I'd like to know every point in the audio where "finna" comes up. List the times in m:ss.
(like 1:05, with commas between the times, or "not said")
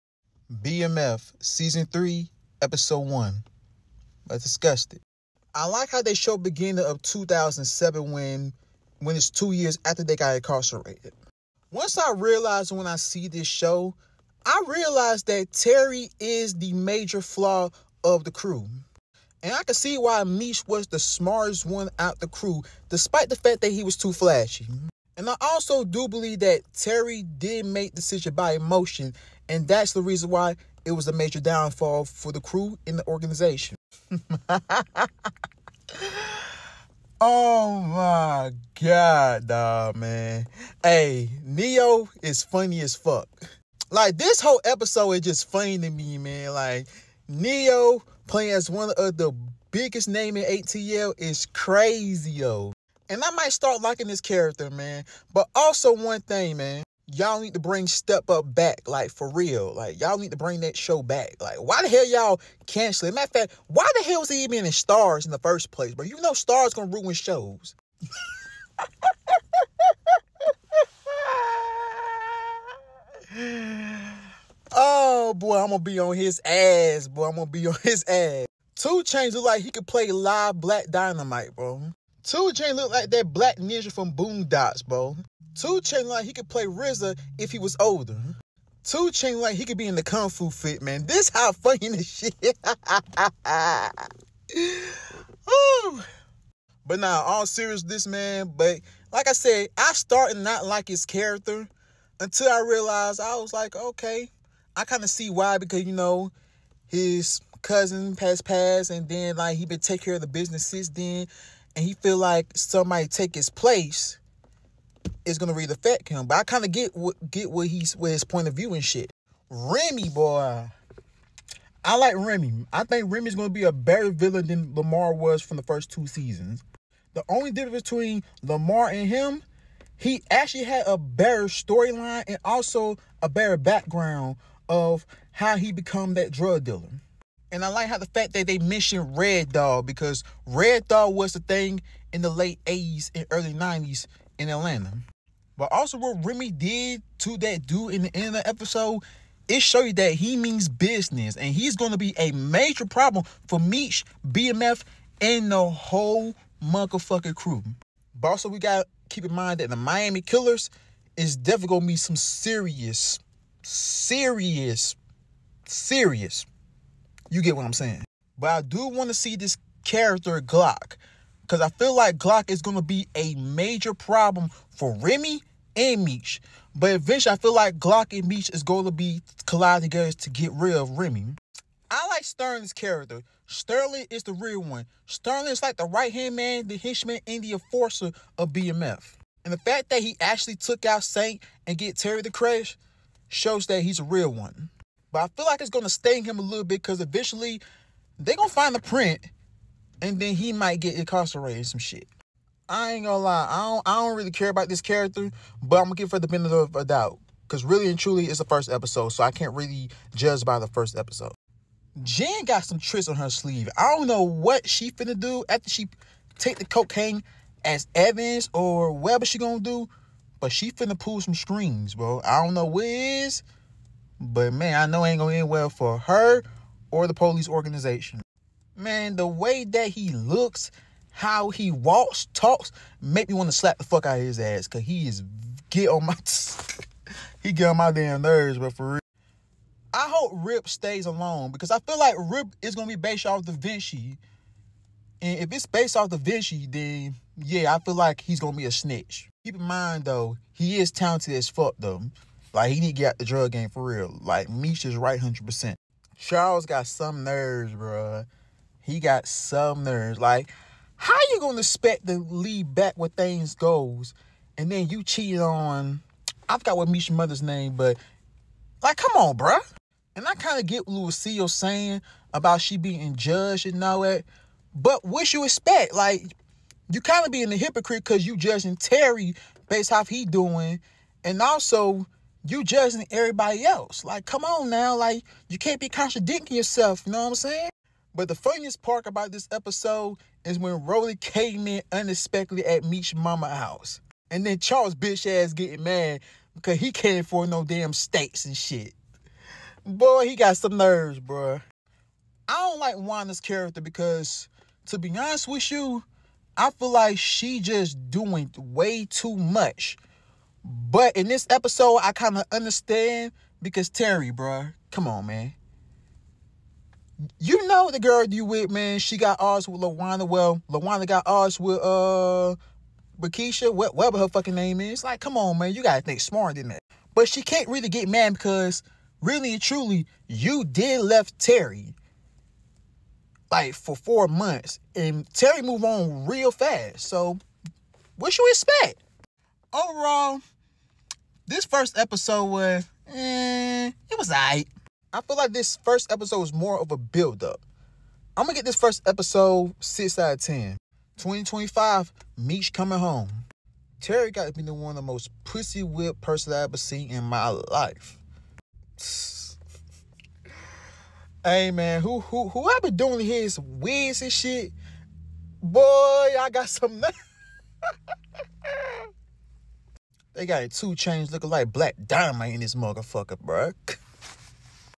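3:34, 3:40.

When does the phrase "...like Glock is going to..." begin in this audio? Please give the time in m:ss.
2:51.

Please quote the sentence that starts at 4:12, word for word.
Like, he need to get out the drug game for real.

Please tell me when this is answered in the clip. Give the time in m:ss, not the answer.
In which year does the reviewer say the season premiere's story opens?
0:07.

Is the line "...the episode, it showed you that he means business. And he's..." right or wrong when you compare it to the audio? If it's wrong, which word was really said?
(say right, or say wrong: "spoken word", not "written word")
right.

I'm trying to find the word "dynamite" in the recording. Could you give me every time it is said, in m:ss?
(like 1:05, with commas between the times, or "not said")
1:20, 6:12.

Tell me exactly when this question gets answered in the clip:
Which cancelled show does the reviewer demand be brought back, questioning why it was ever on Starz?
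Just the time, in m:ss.
0:57.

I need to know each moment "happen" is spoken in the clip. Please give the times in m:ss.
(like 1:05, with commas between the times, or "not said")
not said.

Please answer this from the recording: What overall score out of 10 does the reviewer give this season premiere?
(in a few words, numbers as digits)
6.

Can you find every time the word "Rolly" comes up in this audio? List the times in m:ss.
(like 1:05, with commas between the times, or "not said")
4:50.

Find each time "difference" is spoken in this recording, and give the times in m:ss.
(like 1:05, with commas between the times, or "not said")
2:07.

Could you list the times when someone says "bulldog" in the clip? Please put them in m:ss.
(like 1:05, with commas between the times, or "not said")
not said.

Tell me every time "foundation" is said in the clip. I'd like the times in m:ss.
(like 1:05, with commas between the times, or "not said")
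not said.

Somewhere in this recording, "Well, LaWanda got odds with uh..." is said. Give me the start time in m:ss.
5:20.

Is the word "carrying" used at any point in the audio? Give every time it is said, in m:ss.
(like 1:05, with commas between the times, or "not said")
not said.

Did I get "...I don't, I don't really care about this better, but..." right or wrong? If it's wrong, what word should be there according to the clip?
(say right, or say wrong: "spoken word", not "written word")
wrong: "character", not "better".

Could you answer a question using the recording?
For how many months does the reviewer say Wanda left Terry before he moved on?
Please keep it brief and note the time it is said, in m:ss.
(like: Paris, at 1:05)
4, at 5:33.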